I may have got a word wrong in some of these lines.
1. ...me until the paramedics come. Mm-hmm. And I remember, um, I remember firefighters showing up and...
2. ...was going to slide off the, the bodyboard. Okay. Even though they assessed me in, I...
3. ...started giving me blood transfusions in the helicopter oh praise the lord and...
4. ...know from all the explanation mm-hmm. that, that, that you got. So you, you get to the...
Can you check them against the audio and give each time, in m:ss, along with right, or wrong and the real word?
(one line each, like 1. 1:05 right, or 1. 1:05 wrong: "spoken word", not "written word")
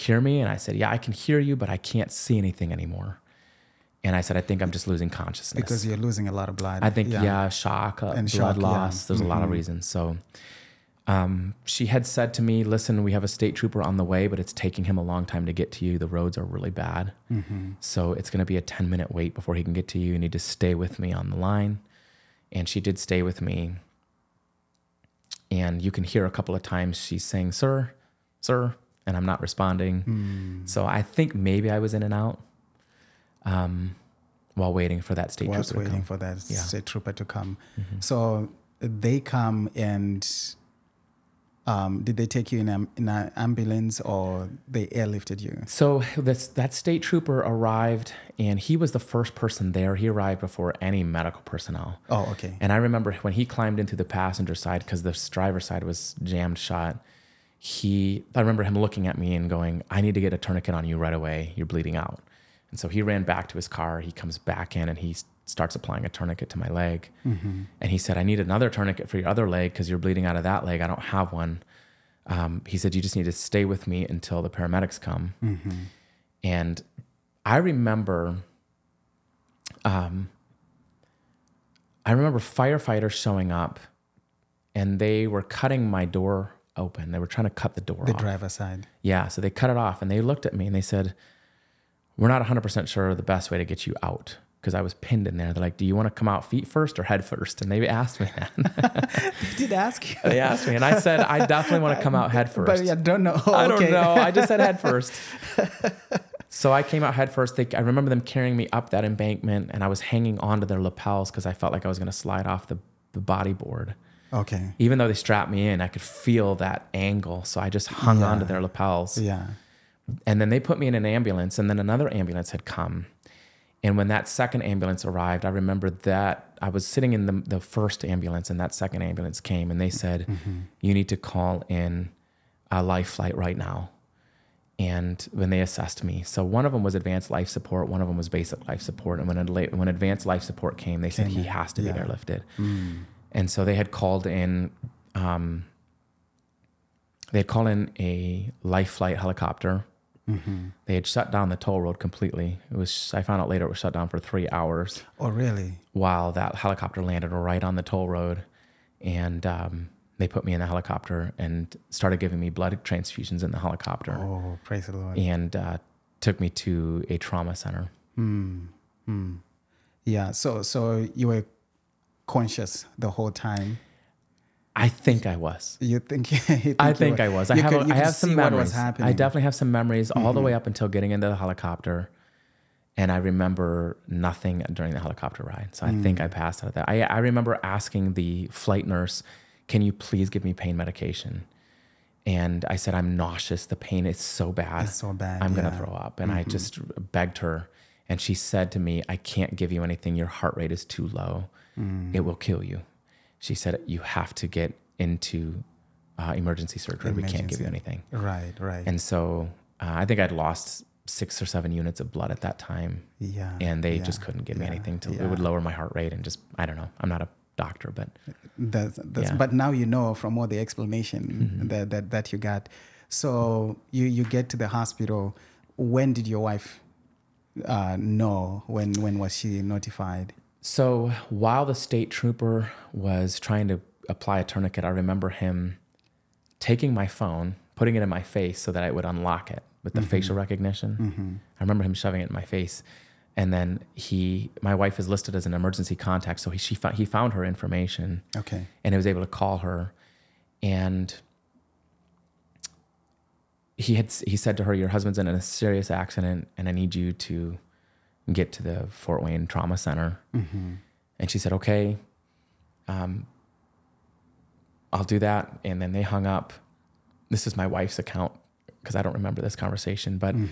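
1. 1:13 right
2. 1:51 wrong: "strapped", not "assessed"
3. 2:41 right
4. 3:39 right.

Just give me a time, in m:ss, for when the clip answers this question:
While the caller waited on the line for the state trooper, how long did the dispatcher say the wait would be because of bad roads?
0:18.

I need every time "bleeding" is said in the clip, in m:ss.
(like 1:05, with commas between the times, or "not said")
1:01, 1:09.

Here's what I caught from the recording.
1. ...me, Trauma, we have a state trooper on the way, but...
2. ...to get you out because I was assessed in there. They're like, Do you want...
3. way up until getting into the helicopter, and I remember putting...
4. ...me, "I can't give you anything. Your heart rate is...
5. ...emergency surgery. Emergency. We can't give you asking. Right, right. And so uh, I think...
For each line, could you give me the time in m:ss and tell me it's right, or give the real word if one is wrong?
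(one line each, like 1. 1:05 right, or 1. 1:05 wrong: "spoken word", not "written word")
1. 0:12 wrong: "Listen", not "Trauma"
2. 1:33 wrong: "pinned", not "assessed"
3. 3:00 wrong: "nothing", not "putting"
4. 3:18 right
5. 3:26 wrong: "anything", not "asking".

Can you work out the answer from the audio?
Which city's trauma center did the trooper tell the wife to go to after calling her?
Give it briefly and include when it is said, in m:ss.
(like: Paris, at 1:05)
Fort Wayne, at 4:18.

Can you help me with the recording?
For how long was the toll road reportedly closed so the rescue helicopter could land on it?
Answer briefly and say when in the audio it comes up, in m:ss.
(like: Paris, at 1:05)
3 hours, at 2:34.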